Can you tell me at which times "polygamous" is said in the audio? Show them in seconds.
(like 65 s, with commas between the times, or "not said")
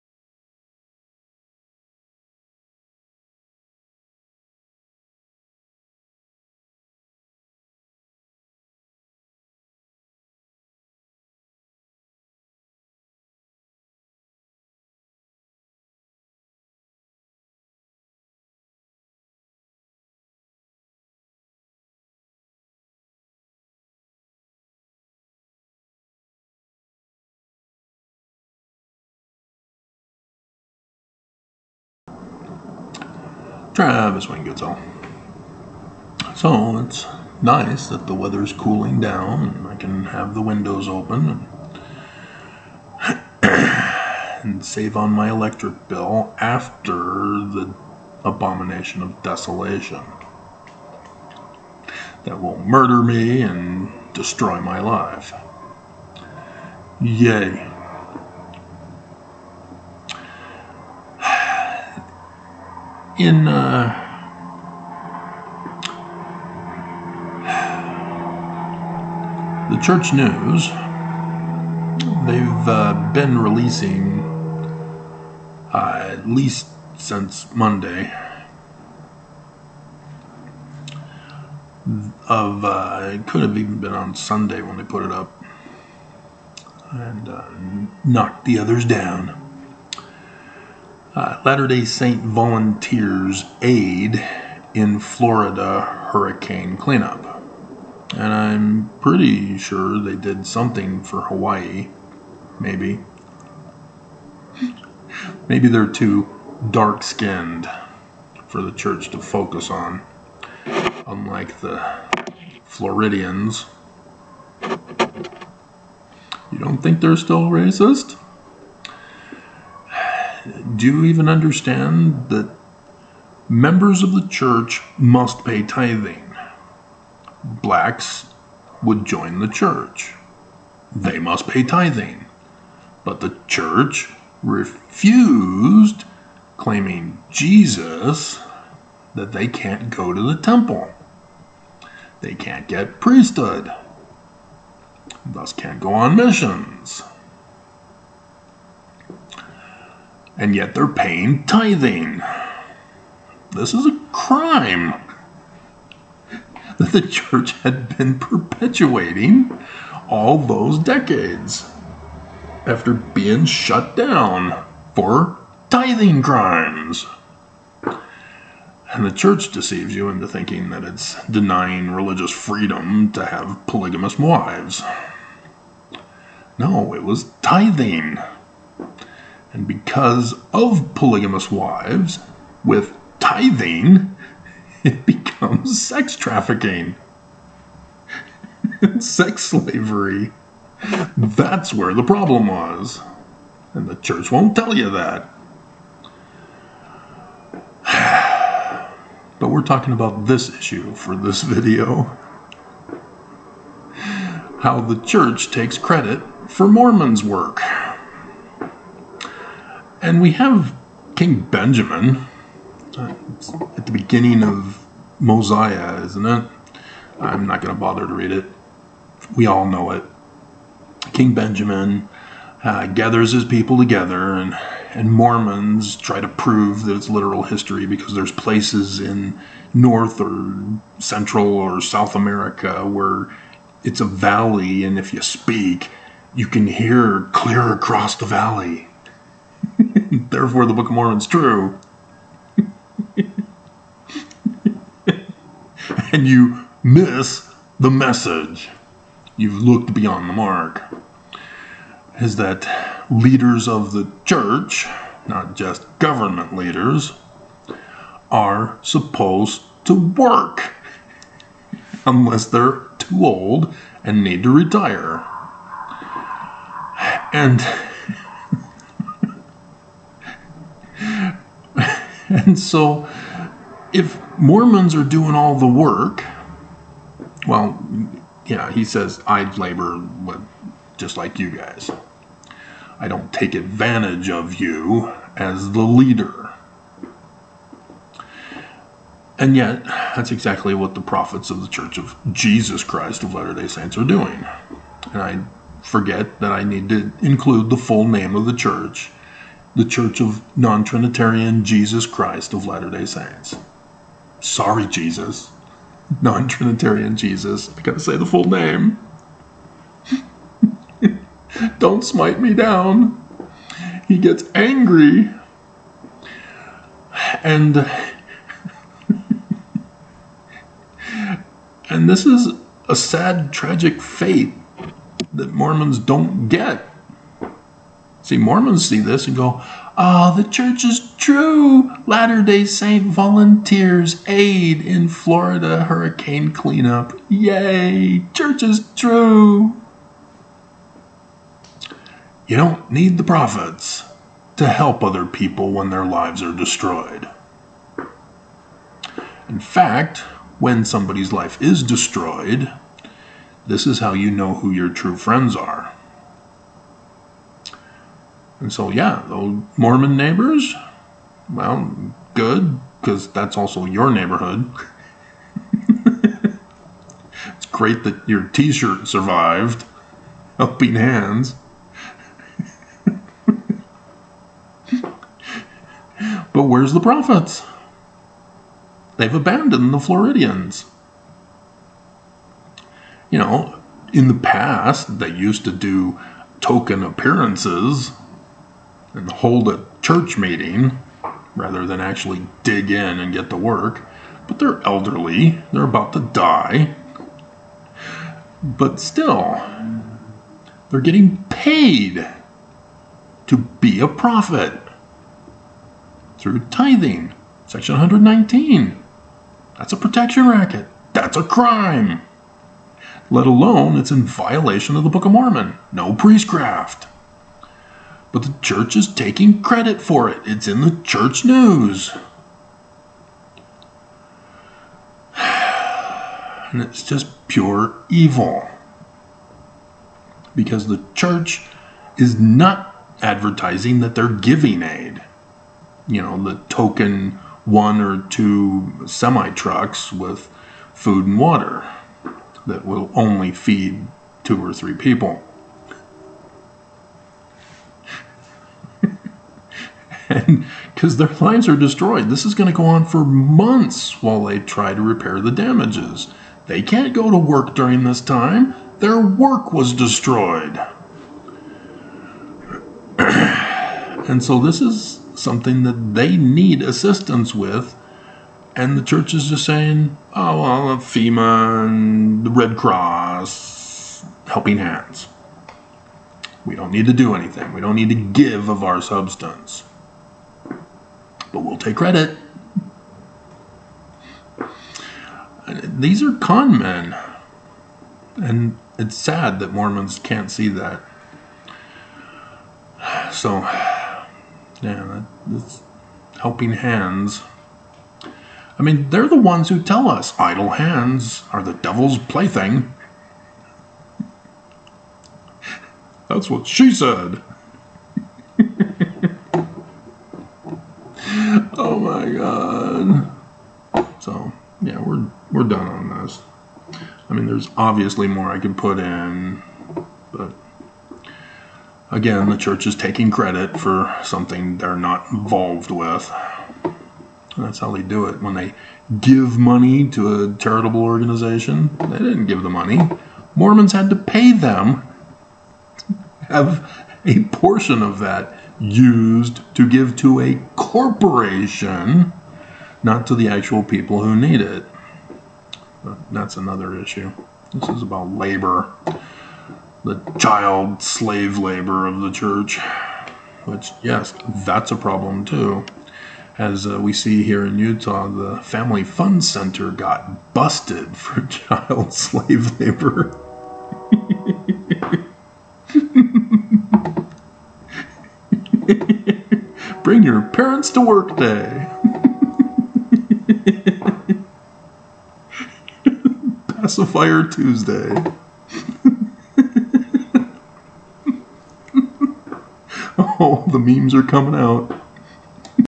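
173 s, 180 s.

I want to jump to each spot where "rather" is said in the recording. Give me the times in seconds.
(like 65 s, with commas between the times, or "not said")
391 s.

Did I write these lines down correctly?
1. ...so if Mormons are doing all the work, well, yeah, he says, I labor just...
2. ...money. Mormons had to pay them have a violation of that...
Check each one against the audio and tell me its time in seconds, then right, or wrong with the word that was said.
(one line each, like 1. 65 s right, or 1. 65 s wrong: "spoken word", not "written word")
1. 272 s right
2. 532 s wrong: "portion", not "violation".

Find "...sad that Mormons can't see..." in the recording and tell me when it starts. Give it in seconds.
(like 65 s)
489 s.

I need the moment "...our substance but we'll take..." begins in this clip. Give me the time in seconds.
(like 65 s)
478 s.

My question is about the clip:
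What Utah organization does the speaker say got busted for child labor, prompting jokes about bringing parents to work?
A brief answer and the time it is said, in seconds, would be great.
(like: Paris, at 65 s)
Family Fund Center, at 558 s.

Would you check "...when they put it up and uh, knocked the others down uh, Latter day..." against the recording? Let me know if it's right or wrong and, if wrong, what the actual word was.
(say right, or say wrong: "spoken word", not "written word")
right.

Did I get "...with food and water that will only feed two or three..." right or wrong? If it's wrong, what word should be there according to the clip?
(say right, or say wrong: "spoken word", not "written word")
right.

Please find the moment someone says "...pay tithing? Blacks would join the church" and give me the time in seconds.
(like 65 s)
125 s.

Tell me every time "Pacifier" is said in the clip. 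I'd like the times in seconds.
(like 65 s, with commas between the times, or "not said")
576 s.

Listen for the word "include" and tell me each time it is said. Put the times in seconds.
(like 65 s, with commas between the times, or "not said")
297 s.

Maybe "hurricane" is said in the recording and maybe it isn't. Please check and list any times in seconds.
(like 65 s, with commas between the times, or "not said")
95 s, 335 s.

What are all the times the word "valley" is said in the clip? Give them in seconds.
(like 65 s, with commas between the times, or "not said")
234 s, 238 s.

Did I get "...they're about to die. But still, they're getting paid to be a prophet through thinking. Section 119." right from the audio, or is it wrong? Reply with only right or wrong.
wrong.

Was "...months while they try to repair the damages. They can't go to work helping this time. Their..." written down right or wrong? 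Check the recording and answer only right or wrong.
wrong.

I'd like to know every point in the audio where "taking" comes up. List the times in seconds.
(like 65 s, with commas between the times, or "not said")
419 s, 522 s.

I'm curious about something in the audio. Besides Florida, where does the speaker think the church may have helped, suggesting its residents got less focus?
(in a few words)
Hawaii.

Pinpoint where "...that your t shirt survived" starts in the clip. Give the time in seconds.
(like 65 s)
368 s.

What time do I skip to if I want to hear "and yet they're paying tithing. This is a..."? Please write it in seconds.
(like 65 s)
150 s.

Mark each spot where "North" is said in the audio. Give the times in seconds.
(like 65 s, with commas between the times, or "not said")
229 s.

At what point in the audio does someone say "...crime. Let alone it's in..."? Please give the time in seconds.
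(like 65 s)
411 s.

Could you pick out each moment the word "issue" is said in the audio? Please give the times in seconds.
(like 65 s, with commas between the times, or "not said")
200 s, 546 s.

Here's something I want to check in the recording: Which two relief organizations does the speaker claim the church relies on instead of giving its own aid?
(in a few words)
FEMA and the Red Cross.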